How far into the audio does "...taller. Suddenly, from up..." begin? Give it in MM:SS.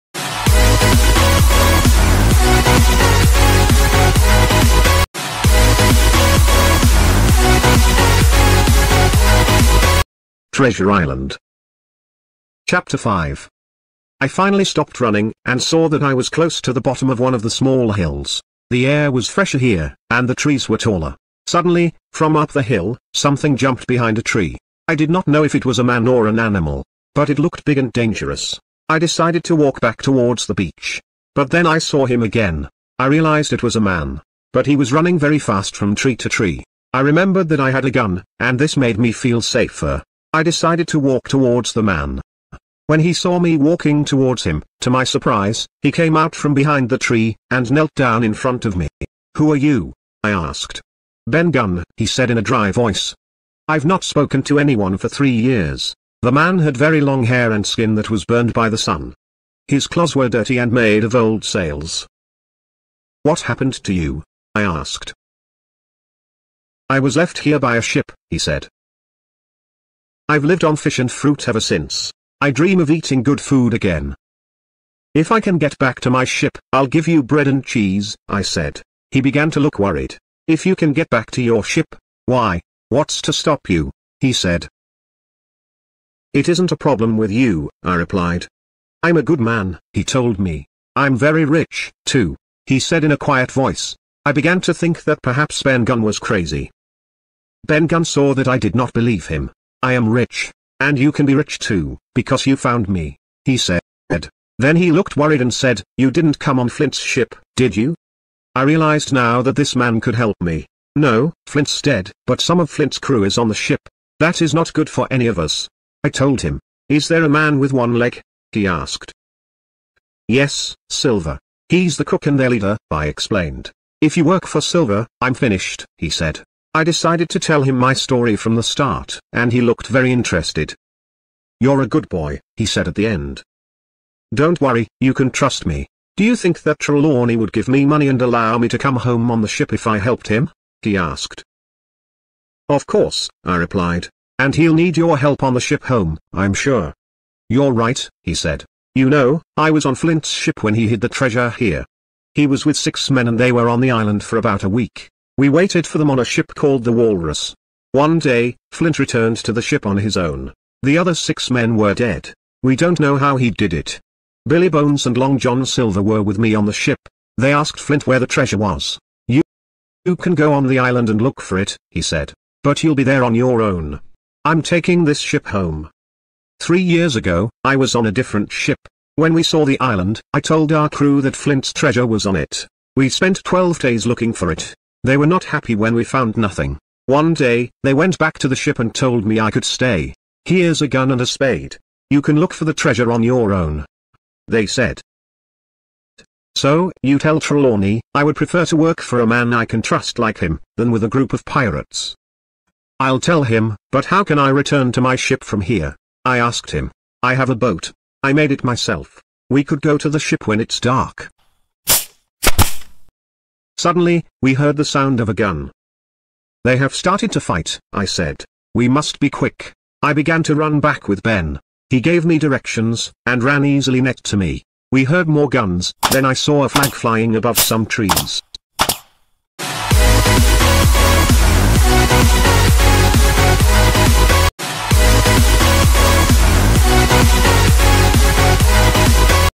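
00:20.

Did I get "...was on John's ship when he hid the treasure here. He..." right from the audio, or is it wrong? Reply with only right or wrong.
wrong.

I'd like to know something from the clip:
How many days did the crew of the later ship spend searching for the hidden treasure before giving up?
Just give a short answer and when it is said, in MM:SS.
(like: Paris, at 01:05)
12, at 03:03.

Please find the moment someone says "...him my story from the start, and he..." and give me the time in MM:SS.
02:07.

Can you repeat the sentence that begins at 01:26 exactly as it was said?
It isn't a problem with you, I replied.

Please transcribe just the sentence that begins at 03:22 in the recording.
I'll tell him, but how can I return to my ship from here?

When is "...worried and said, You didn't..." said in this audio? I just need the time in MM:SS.
01:45.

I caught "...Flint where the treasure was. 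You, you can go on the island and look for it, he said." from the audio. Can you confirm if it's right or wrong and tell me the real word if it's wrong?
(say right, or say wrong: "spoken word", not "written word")
right.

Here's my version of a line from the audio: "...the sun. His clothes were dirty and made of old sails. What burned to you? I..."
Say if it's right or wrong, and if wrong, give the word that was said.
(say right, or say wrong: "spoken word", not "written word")
wrong: "happened", not "burned".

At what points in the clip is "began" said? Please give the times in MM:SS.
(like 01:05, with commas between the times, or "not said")
01:19, 01:34, 03:40.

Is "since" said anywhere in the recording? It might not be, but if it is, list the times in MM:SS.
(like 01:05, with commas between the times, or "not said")
01:11.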